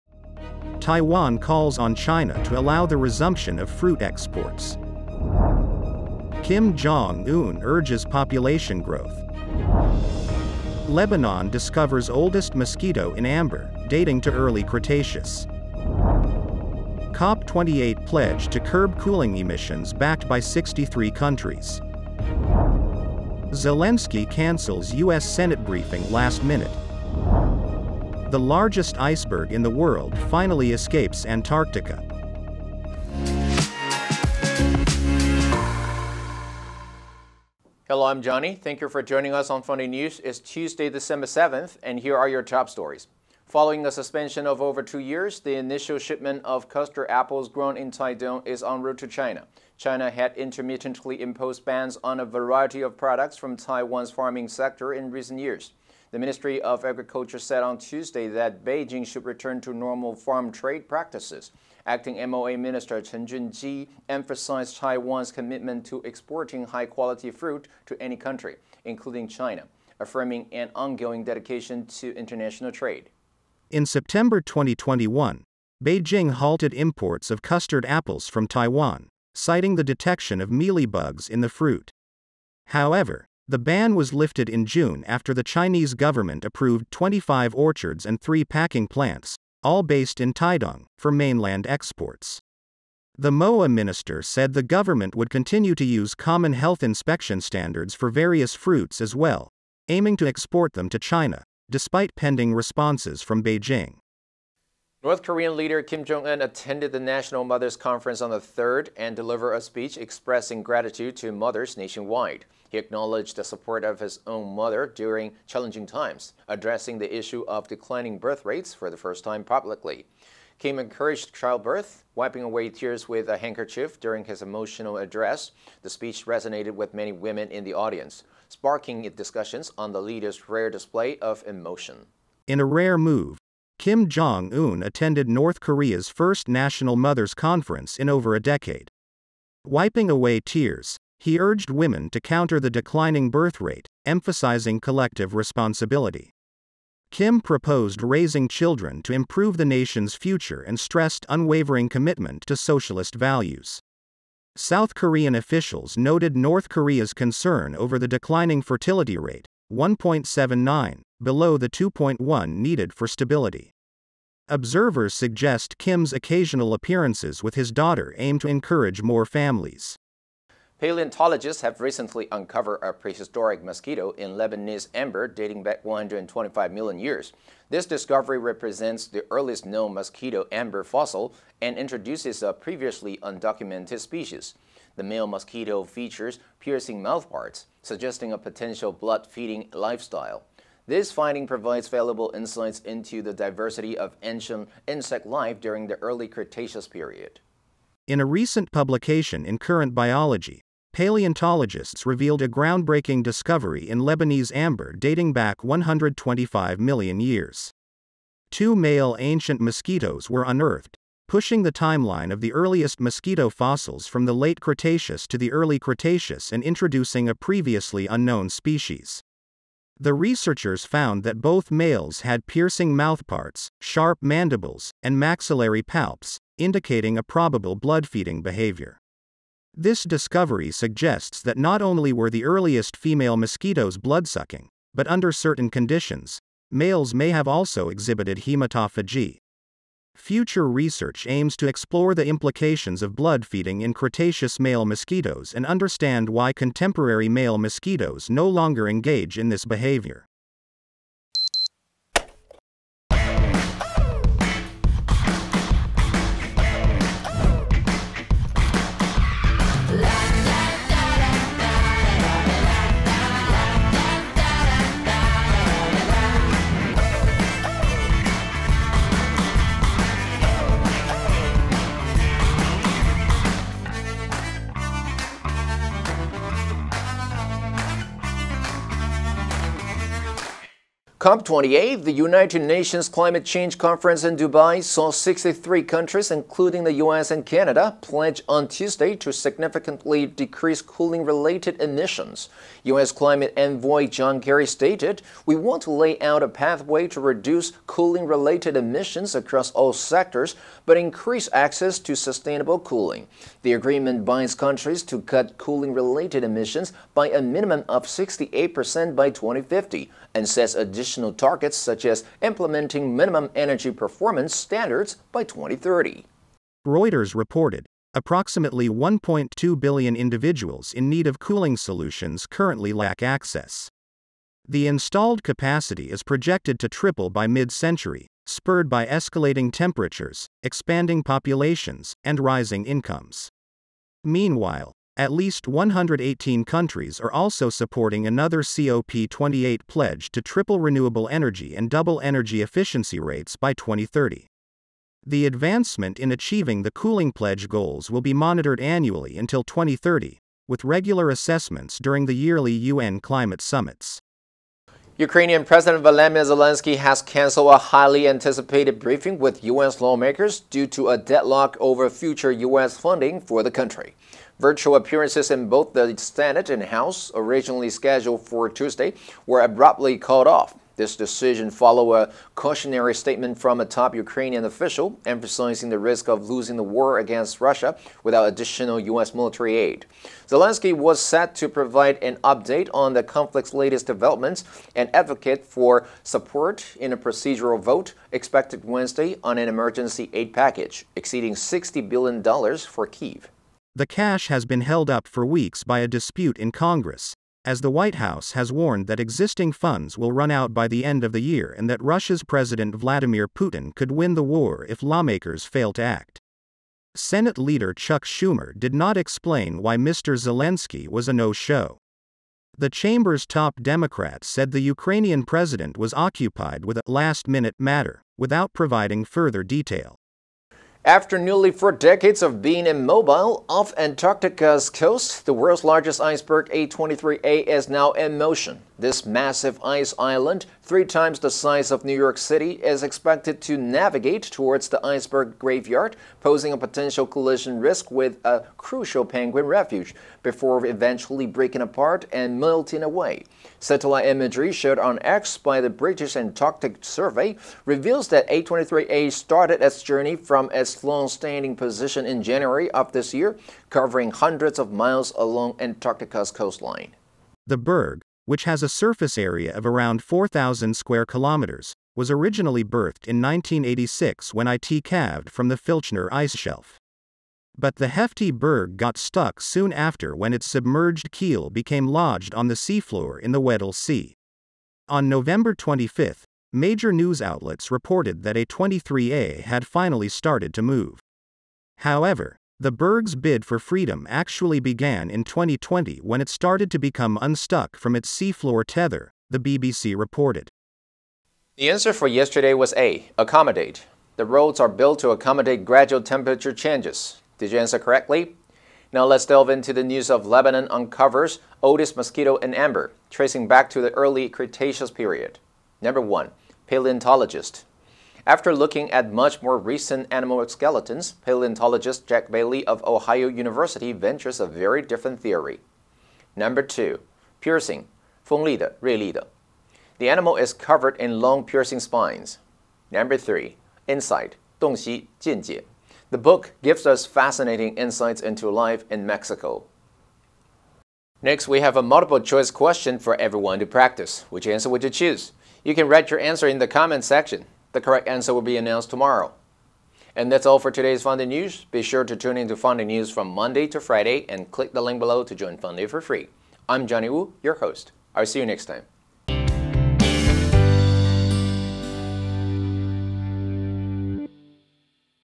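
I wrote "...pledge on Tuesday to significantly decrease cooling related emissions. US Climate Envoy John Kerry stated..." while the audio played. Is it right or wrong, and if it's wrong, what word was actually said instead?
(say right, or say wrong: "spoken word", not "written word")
right.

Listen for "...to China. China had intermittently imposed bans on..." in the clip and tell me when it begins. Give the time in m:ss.
0:48.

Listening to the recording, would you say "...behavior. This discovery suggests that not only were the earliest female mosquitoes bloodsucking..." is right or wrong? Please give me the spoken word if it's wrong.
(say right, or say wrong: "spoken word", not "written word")
right.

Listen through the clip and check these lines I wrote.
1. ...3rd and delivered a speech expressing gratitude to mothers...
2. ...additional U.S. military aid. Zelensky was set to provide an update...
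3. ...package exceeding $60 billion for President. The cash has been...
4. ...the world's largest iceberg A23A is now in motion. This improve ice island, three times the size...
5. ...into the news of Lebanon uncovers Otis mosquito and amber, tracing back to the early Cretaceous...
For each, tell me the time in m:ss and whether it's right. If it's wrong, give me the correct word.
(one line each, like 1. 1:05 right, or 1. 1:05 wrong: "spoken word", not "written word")
1. 1:48 right
2. 6:18 right
3. 6:30 wrong: "Kiev", not "President"
4. 7:05 wrong: "massive", not "improve"
5. 8:19 right.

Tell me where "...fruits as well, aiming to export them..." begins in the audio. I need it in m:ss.
1:38.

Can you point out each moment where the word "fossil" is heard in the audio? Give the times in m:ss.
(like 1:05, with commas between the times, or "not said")
3:00, 3:33.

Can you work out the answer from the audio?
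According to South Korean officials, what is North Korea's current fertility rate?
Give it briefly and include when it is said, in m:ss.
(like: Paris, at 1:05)
1.79, at 2:39.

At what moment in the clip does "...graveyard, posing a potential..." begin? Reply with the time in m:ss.
7:15.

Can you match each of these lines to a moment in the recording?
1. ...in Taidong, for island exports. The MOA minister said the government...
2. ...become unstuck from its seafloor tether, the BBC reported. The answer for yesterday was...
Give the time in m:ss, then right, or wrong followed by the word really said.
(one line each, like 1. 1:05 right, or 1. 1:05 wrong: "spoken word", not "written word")
1. 1:30 wrong: "mainland", not "island"
2. 8:06 right.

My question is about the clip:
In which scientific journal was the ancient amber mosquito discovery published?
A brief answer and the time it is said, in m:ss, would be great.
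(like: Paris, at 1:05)
Current Biology, at 3:19.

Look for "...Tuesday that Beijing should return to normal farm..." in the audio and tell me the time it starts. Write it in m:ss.
0:57.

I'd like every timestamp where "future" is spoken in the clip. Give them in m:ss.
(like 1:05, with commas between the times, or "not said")
2:30, 4:00, 6:02.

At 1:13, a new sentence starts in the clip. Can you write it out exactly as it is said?
In September 2021, Beijing halted imports of custard apples from Taiwan, citing the detection of mealybugs in the fruit.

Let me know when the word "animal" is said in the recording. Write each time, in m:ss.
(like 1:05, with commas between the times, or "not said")
8:30, 8:40.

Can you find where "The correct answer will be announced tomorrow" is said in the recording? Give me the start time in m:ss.
8:57.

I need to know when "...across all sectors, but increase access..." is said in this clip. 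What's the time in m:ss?
4:59.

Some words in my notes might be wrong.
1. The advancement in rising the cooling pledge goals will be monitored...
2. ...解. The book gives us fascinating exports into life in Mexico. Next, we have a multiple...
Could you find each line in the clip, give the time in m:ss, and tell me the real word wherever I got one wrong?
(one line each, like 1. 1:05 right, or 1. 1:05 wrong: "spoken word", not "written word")
1. 5:45 wrong: "achieving", not "rising"
2. 8:45 wrong: "insights", not "exports".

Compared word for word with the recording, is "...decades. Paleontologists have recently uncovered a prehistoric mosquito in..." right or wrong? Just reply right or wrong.
wrong.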